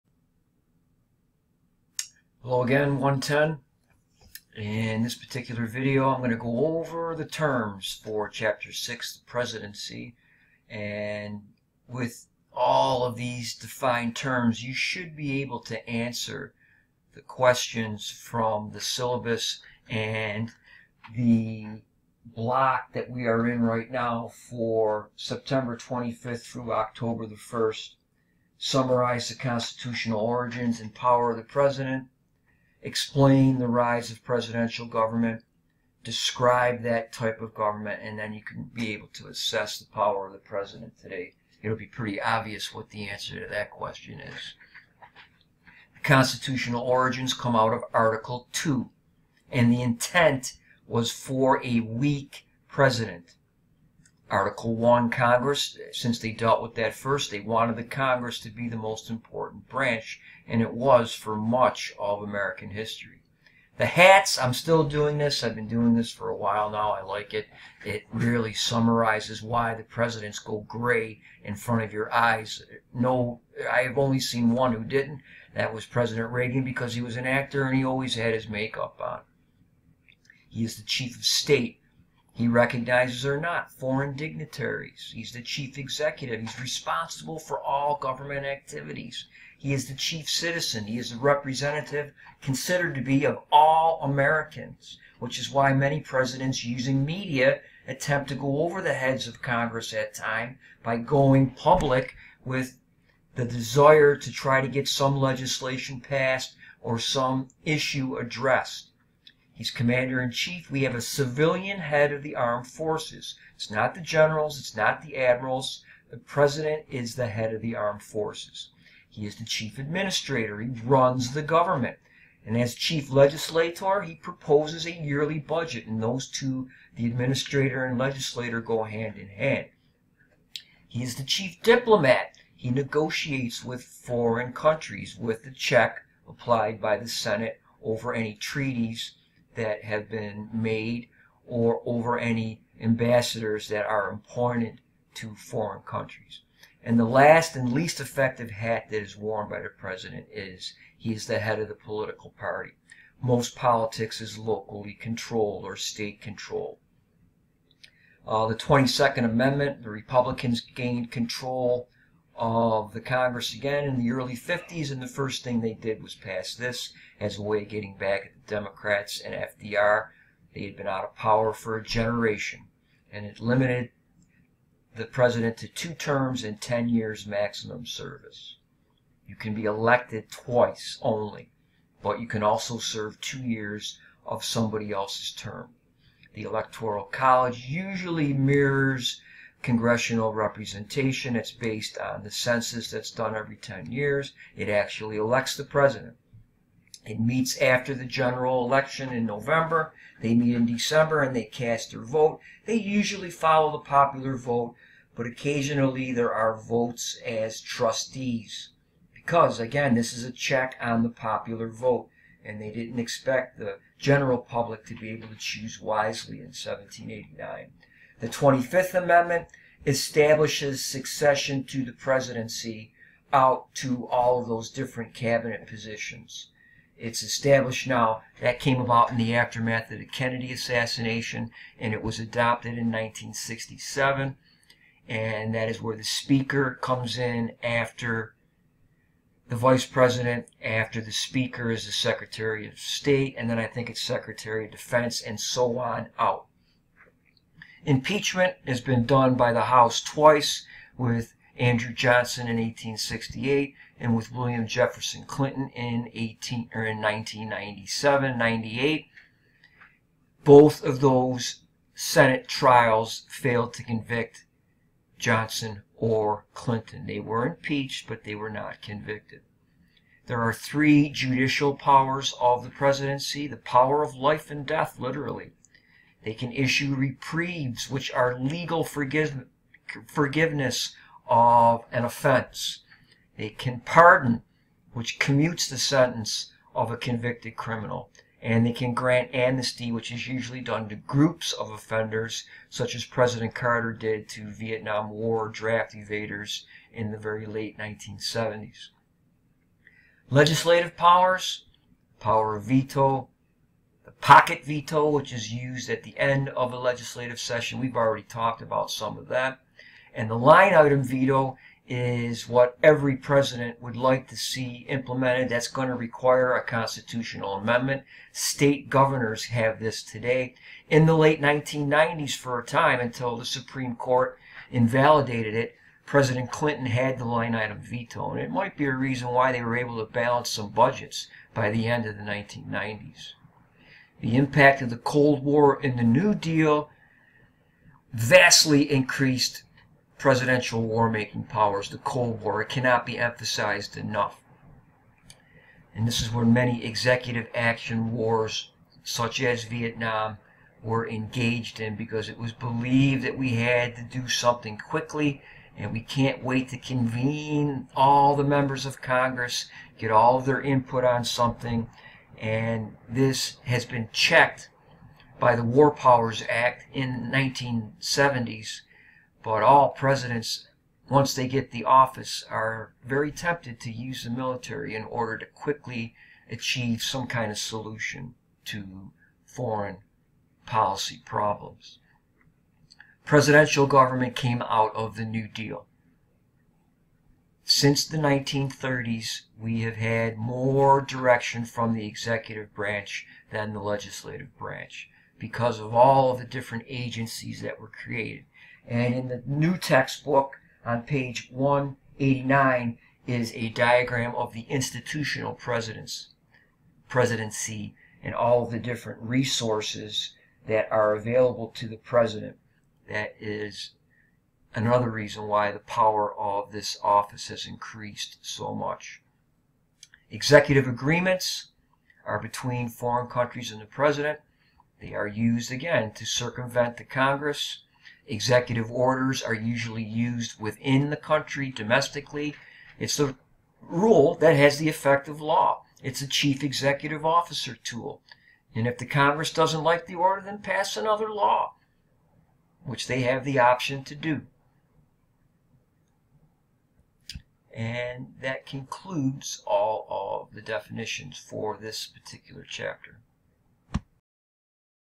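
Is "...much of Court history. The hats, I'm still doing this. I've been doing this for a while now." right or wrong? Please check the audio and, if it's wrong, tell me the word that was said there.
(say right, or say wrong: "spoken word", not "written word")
wrong: "American", not "Court".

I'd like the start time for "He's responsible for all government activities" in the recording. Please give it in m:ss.
1:26.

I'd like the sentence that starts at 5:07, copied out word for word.
We've already talked about some of that.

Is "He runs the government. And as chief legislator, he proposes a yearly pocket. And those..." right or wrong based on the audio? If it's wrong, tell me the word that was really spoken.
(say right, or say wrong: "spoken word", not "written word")
wrong: "budget", not "pocket".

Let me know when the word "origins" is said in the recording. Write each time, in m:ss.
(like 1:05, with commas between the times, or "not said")
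0:30, 0:46.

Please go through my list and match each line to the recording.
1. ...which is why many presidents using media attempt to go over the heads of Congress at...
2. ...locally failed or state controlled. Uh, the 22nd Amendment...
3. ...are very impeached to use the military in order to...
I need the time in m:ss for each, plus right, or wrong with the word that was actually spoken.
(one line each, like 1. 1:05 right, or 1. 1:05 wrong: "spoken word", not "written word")
1. 1:35 right
2. 2:34 wrong: "controlled", not "failed"
3. 6:12 wrong: "tempted", not "impeached".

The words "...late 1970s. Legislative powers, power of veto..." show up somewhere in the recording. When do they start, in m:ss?
4:57.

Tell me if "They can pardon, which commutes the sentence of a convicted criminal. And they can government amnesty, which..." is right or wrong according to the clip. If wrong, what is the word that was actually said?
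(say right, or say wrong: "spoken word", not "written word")
wrong: "grant", not "government".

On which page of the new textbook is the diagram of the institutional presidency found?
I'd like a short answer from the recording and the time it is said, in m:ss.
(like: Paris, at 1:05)
189, at 6:41.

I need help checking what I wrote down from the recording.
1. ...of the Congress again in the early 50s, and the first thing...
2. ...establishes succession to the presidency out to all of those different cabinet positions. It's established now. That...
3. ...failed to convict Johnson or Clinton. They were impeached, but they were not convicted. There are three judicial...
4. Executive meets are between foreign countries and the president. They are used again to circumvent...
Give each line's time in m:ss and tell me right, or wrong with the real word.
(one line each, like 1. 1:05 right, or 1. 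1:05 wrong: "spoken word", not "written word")
1. 2:42 right
2. 3:39 right
3. 4:23 right
4. 7:00 wrong: "agreements", not "meets".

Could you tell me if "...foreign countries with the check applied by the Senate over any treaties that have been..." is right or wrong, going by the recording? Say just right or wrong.
right.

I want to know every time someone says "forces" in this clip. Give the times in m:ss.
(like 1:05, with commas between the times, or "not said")
1:52, 1:58.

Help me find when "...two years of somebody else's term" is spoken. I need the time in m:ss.
3:03.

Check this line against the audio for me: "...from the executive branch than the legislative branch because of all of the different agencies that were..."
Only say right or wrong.
right.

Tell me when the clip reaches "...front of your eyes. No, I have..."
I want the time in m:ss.
1:11.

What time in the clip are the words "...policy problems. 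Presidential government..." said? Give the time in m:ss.
6:20.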